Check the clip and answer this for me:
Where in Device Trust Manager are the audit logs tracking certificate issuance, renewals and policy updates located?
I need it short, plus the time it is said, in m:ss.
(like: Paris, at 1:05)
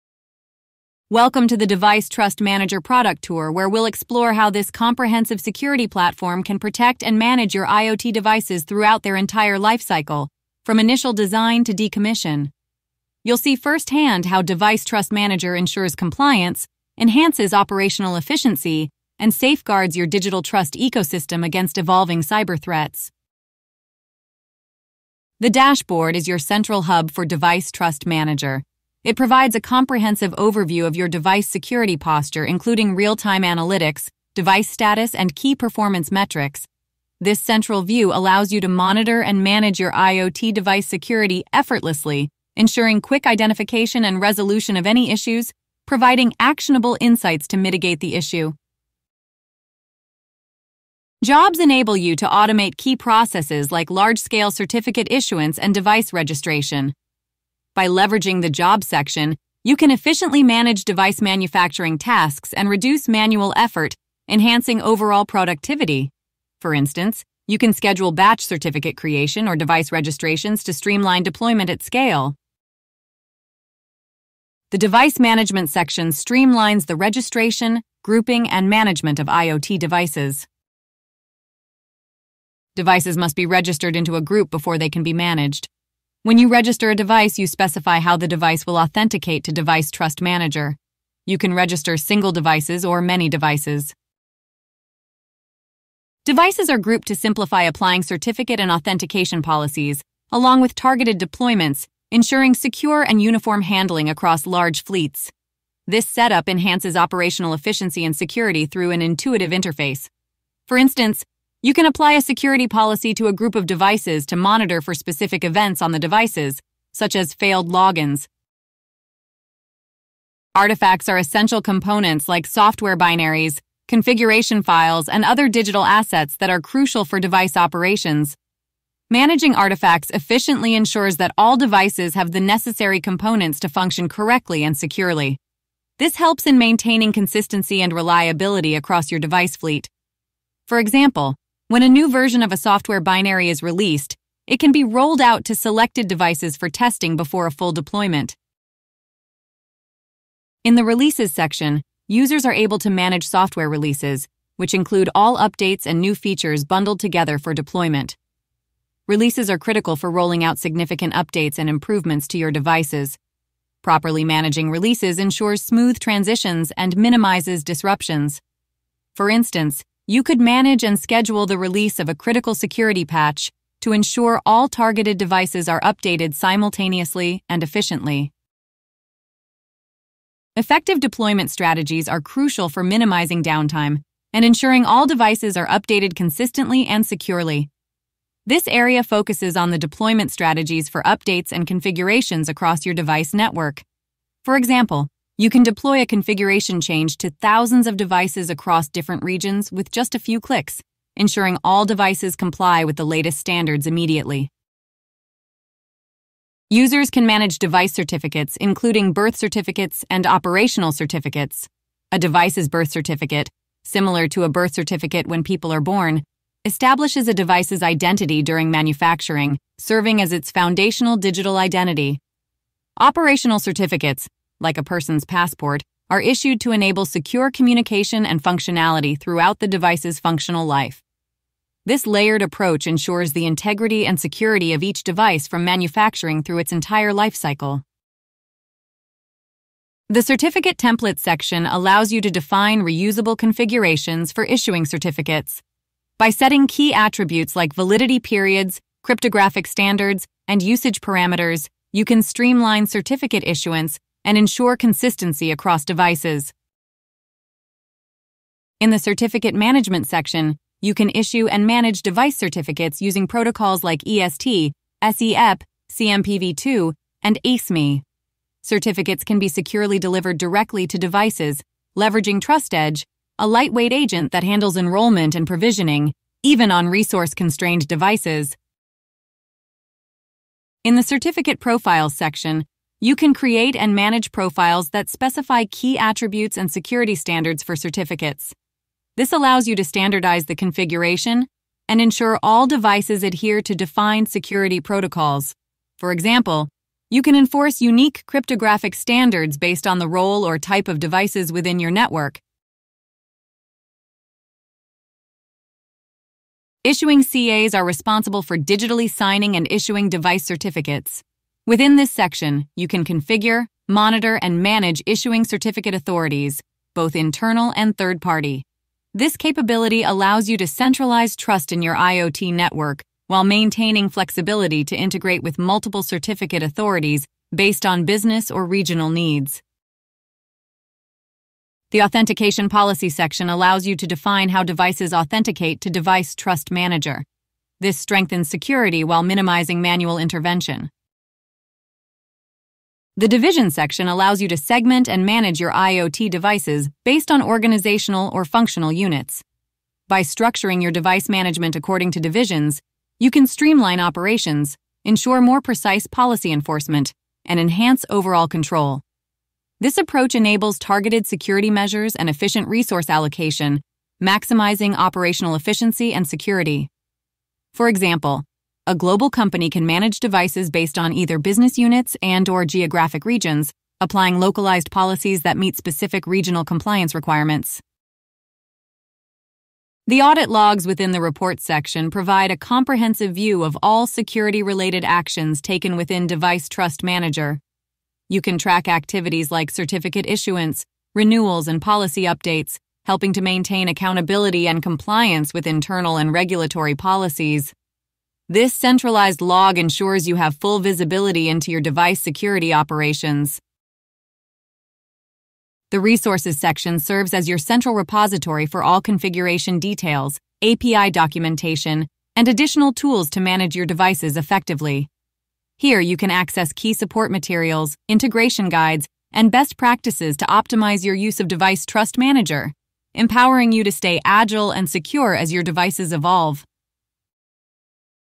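report section, at 6:21.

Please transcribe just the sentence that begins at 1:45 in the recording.
This setup enhances operational efficiency and security through an intuitive interface.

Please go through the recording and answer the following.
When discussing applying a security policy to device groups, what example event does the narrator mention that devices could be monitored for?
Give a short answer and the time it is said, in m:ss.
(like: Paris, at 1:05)
failed logins, at 1:57.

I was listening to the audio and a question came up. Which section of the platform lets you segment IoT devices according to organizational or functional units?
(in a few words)
division section.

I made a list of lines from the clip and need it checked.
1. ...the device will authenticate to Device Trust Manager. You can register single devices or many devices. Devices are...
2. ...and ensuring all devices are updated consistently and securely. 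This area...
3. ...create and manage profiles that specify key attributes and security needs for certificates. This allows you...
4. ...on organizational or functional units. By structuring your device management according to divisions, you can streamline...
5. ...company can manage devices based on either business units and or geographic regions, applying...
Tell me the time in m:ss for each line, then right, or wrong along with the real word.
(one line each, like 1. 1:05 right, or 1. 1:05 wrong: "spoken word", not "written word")
1. 1:28 right
2. 3:04 right
3. 4:43 wrong: "standards", not "needs"
4. 5:47 right
5. 6:09 right.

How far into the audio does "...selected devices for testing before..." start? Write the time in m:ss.
2:25.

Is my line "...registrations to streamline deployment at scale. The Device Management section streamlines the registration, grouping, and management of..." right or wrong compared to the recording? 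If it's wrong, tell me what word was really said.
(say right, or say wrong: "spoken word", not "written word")
right.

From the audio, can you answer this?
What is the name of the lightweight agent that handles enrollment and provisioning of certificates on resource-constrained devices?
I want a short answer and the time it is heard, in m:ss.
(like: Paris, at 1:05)
TrustEdge, at 4:32.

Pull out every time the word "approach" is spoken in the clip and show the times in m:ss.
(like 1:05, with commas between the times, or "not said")
3:52, 5:59.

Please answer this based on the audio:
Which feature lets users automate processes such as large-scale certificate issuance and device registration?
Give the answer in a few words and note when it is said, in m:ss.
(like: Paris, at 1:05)
Jobs, at 0:51.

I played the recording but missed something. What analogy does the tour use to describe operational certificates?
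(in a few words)
a person's passport.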